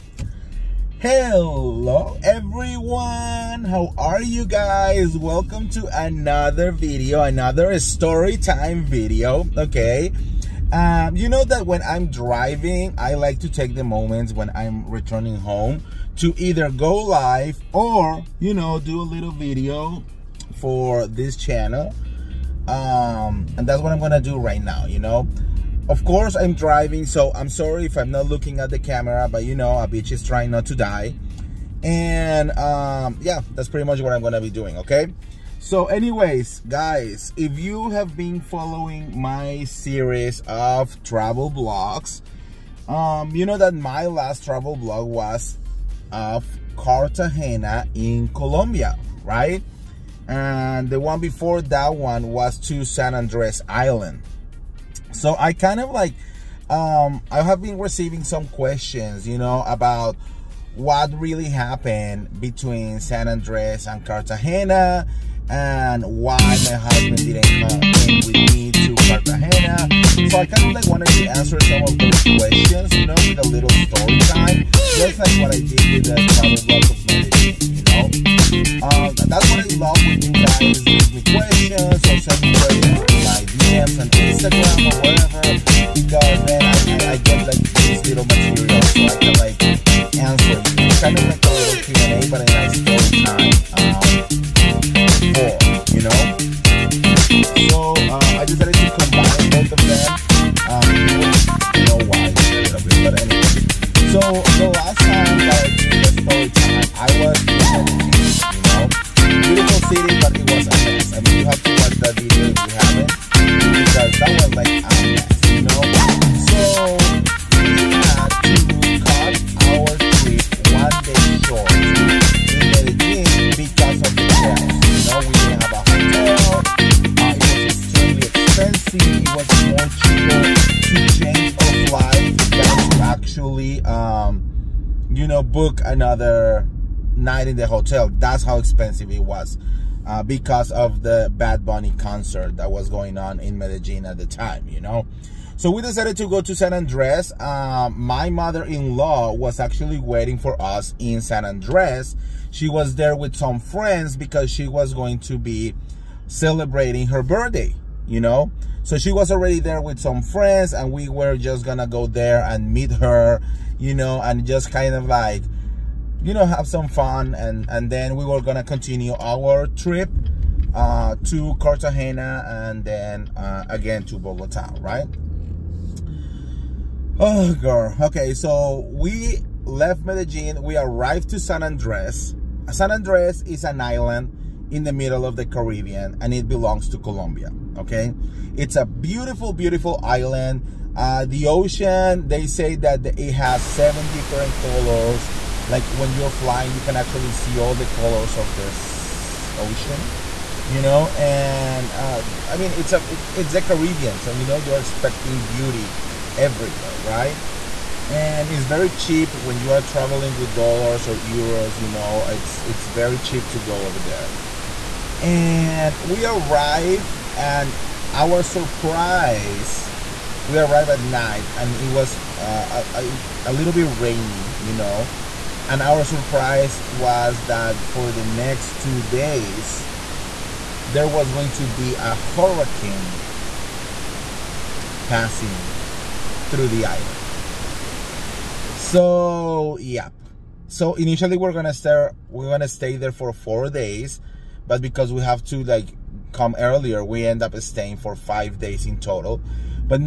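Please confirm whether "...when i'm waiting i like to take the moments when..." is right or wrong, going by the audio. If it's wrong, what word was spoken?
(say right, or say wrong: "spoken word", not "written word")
wrong: "driving", not "waiting".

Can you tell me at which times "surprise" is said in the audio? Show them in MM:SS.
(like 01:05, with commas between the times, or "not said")
03:38, 03:46.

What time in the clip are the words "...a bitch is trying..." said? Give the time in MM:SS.
00:29.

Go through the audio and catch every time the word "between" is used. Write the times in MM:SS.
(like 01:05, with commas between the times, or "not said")
01:02.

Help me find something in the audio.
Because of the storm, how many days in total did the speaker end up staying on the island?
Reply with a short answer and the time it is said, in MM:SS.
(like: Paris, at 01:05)
5, at 04:08.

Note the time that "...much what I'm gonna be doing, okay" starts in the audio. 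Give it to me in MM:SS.
00:33.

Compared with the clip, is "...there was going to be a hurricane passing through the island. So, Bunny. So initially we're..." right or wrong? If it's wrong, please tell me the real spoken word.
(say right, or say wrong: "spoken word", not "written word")
wrong: "Yeah", not "Bunny".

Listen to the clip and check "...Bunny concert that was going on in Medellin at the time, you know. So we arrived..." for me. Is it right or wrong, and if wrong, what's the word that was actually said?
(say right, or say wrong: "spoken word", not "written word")
wrong: "decided", not "arrived".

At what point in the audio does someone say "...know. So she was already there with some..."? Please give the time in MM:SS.
02:38.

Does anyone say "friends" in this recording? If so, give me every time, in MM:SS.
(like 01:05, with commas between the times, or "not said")
02:33, 02:40.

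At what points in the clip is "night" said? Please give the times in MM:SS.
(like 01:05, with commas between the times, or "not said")
02:17, 03:40.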